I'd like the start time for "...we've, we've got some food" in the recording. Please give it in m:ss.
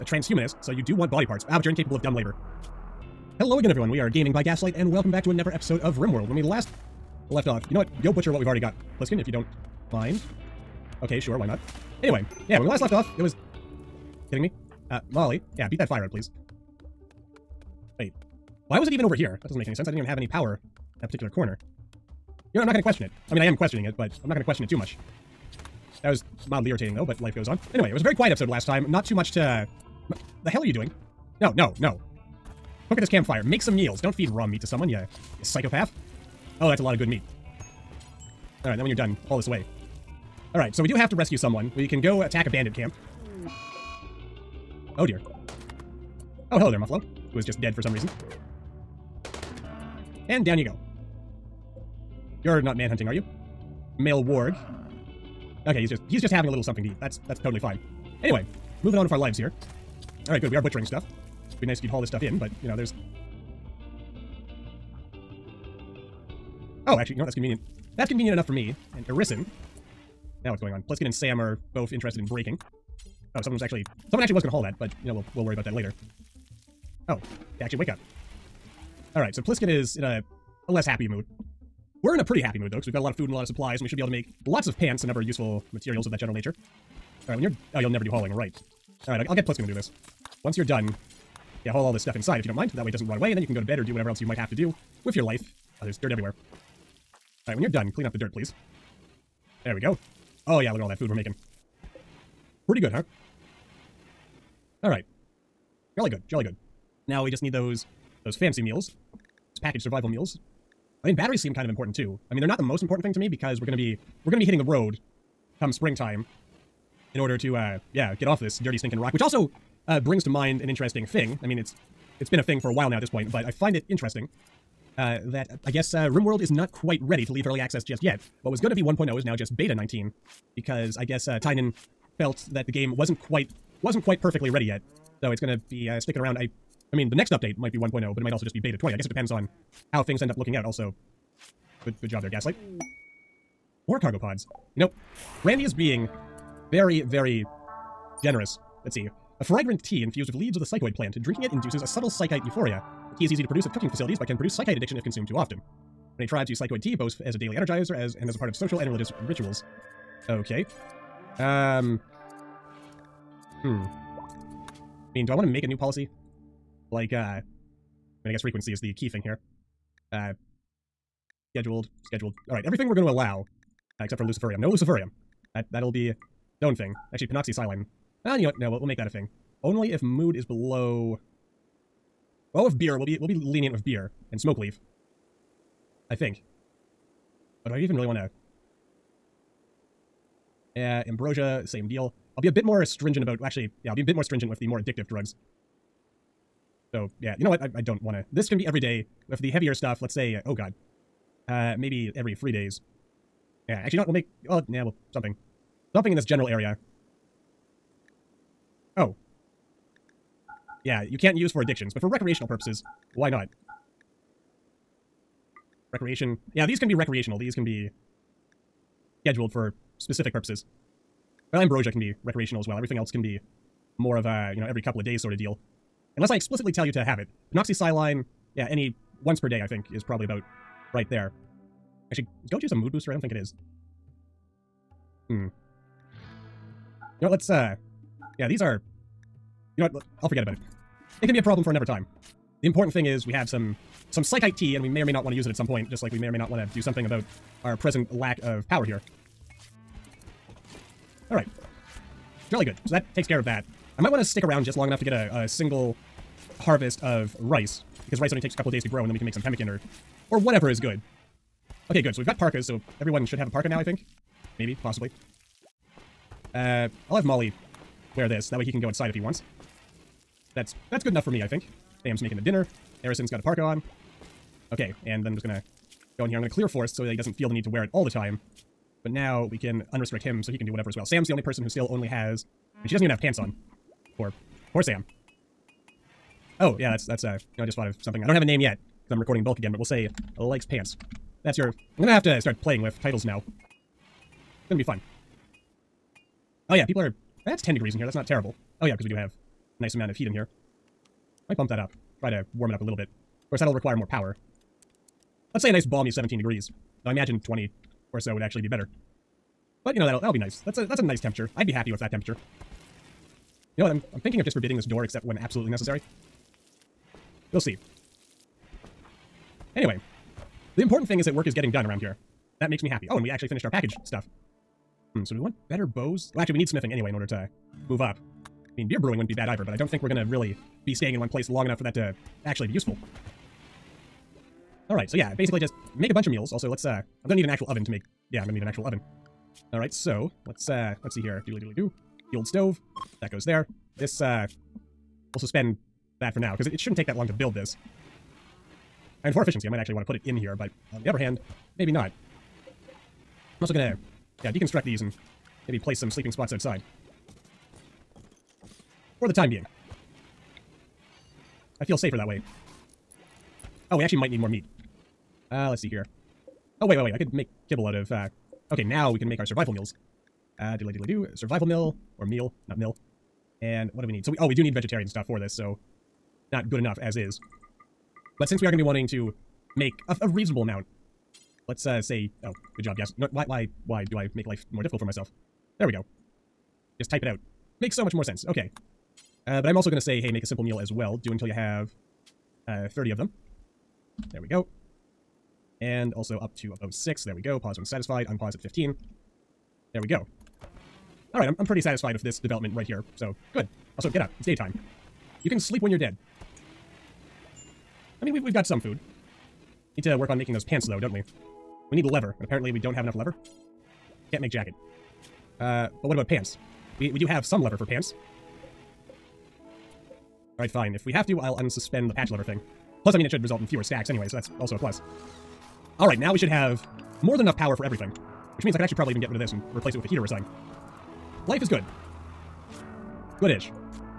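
6:48.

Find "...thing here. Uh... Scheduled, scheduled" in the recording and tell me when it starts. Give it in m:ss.
2:49.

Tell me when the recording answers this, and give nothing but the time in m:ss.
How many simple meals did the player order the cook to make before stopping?
6:32.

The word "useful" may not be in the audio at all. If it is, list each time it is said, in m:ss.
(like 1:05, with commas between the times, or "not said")
1:25, 5:32.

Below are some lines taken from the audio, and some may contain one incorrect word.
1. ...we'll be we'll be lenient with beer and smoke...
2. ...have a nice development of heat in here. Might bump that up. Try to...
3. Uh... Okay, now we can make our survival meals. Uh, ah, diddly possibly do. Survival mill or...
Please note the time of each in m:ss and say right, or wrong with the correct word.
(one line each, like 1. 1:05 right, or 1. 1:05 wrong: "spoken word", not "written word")
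1. 3:02 right
2. 4:59 wrong: "amount", not "development"
3. 6:08 wrong: "diddly", not "possibly".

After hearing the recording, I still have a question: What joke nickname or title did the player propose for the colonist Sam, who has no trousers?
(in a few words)
Likes pants.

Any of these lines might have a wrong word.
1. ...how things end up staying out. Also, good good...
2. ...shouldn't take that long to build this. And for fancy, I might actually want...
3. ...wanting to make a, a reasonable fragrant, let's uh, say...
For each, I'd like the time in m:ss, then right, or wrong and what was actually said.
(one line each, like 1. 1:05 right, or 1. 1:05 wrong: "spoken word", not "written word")
1. 2:19 wrong: "looking", not "staying"
2. 5:46 wrong: "efficiency", not "fancy"
3. 6:18 wrong: "amount", not "fragrant".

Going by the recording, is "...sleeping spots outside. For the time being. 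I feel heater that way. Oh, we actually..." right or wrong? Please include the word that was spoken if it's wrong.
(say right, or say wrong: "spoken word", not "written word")
wrong: "safer", not "heater".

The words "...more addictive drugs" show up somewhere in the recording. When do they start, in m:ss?
3:14.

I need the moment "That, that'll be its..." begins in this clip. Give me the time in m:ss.
2:55.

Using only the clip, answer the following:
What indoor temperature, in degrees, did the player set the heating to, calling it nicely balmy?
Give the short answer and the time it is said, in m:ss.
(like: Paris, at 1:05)
17, at 5:06.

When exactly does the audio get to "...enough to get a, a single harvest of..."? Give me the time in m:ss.
4:14.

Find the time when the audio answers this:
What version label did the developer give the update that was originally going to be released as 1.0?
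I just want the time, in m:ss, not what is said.
2:09.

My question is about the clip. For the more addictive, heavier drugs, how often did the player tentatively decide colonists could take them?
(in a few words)
Every three days.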